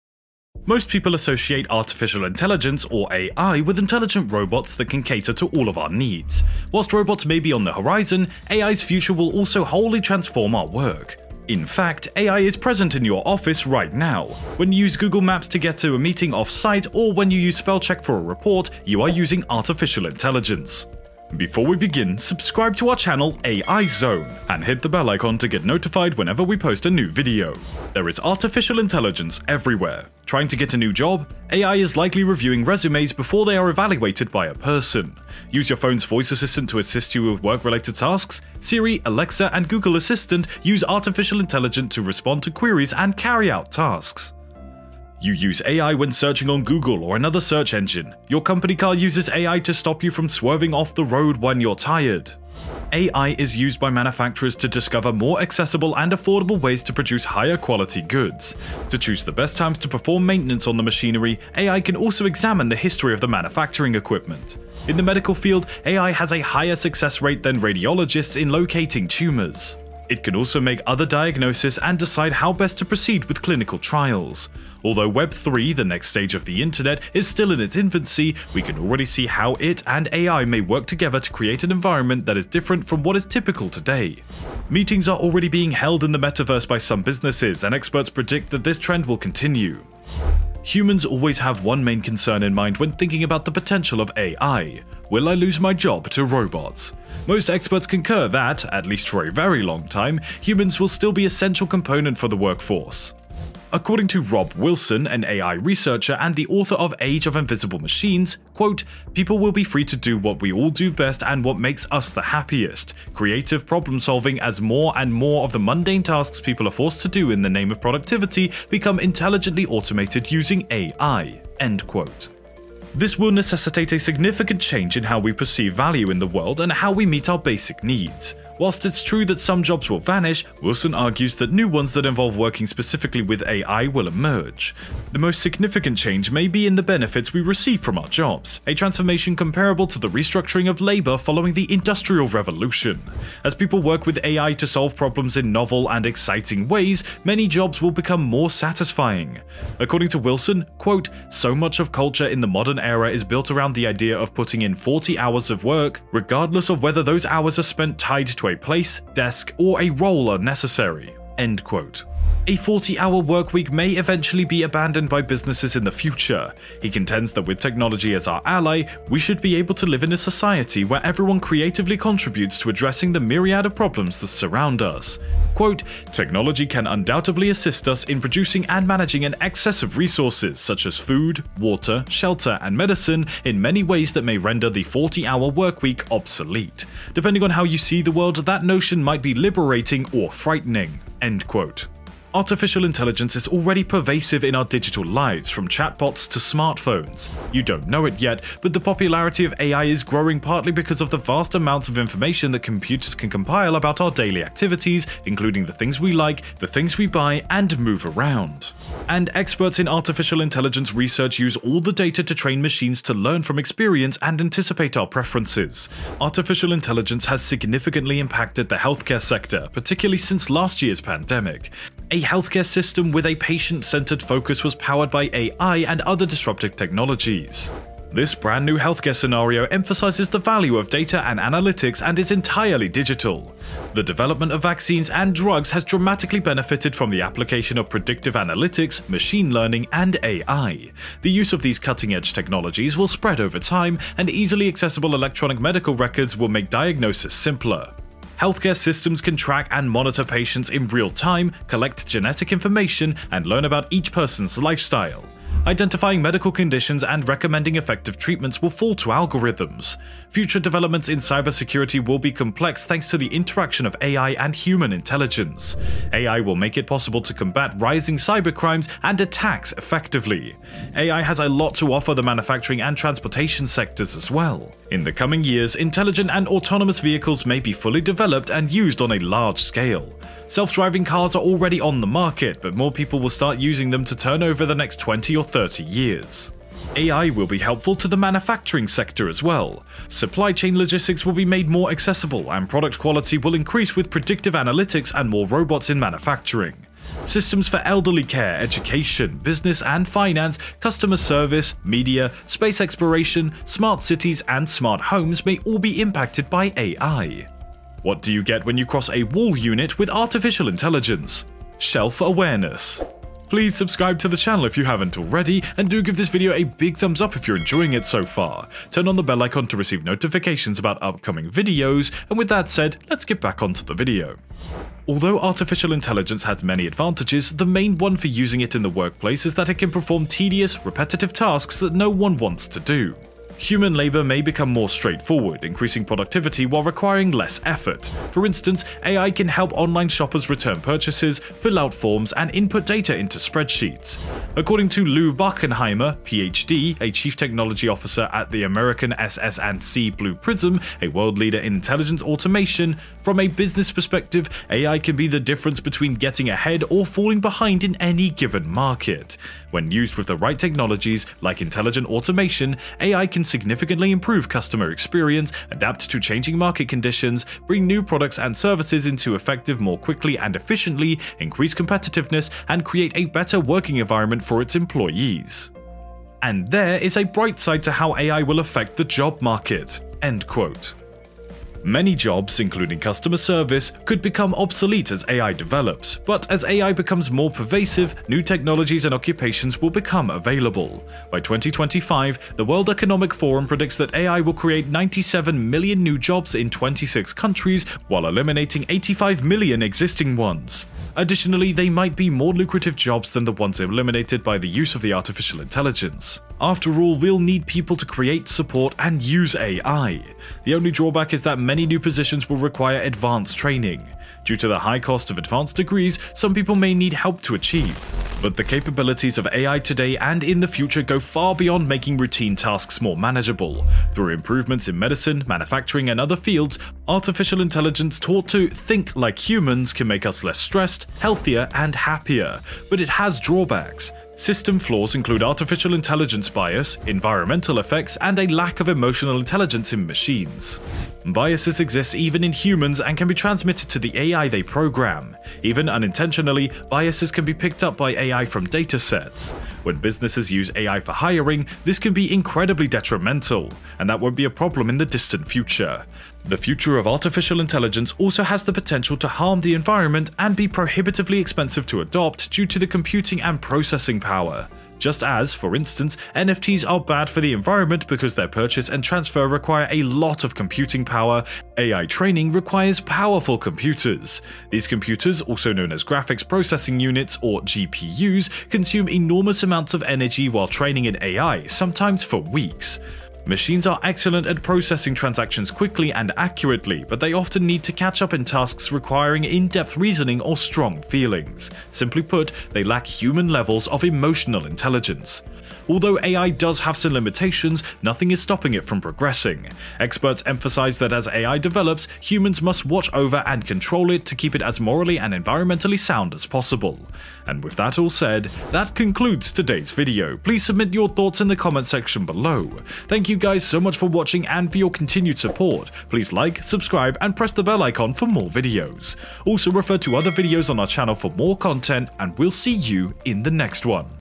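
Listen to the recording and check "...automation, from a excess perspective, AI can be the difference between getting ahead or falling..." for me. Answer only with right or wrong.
wrong.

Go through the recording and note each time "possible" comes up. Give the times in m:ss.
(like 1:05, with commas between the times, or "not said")
4:26, 8:26.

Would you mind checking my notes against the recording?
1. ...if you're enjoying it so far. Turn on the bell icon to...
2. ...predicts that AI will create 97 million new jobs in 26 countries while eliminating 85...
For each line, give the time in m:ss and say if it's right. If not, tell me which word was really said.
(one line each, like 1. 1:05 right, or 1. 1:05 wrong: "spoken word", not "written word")
1. 5:17 right
2. 6:33 right.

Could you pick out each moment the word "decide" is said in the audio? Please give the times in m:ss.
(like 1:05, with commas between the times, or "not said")
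1:11.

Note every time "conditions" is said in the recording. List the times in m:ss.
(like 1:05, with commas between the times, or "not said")
4:16, 6:06.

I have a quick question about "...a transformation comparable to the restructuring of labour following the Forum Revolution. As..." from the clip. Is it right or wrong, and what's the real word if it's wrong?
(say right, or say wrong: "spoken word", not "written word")
wrong: "Industrial", not "Forum".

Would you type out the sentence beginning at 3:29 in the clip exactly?
And experts in artificial intelligence research use all the data to train machines to learn from experience and anticipate our preferences.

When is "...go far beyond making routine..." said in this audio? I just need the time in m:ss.
7:01.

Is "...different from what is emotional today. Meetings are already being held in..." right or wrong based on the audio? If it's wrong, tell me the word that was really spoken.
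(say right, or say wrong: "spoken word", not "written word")
wrong: "typical", not "emotional".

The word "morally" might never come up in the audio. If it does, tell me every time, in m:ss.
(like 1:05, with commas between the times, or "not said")
8:24.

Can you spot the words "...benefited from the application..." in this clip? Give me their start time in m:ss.
3:56.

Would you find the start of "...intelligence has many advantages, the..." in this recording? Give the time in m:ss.
5:25.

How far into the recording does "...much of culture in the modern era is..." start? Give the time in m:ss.
2:31.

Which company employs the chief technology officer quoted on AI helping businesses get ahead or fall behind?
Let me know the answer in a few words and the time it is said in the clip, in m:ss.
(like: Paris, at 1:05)
SS&C Blue Prism, at 5:49.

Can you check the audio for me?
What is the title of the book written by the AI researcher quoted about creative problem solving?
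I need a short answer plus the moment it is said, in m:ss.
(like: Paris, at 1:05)
Age of Invisible Machines, at 1:46.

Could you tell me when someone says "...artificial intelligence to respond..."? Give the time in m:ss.
0:40.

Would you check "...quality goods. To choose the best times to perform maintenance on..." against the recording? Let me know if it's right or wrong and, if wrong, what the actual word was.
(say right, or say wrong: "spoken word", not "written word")
right.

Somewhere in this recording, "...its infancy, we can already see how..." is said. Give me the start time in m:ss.
1:17.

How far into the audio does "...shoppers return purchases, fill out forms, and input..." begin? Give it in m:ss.
5:40.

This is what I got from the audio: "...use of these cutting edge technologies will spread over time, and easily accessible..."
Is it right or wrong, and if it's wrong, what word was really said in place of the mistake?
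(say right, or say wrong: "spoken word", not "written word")
right.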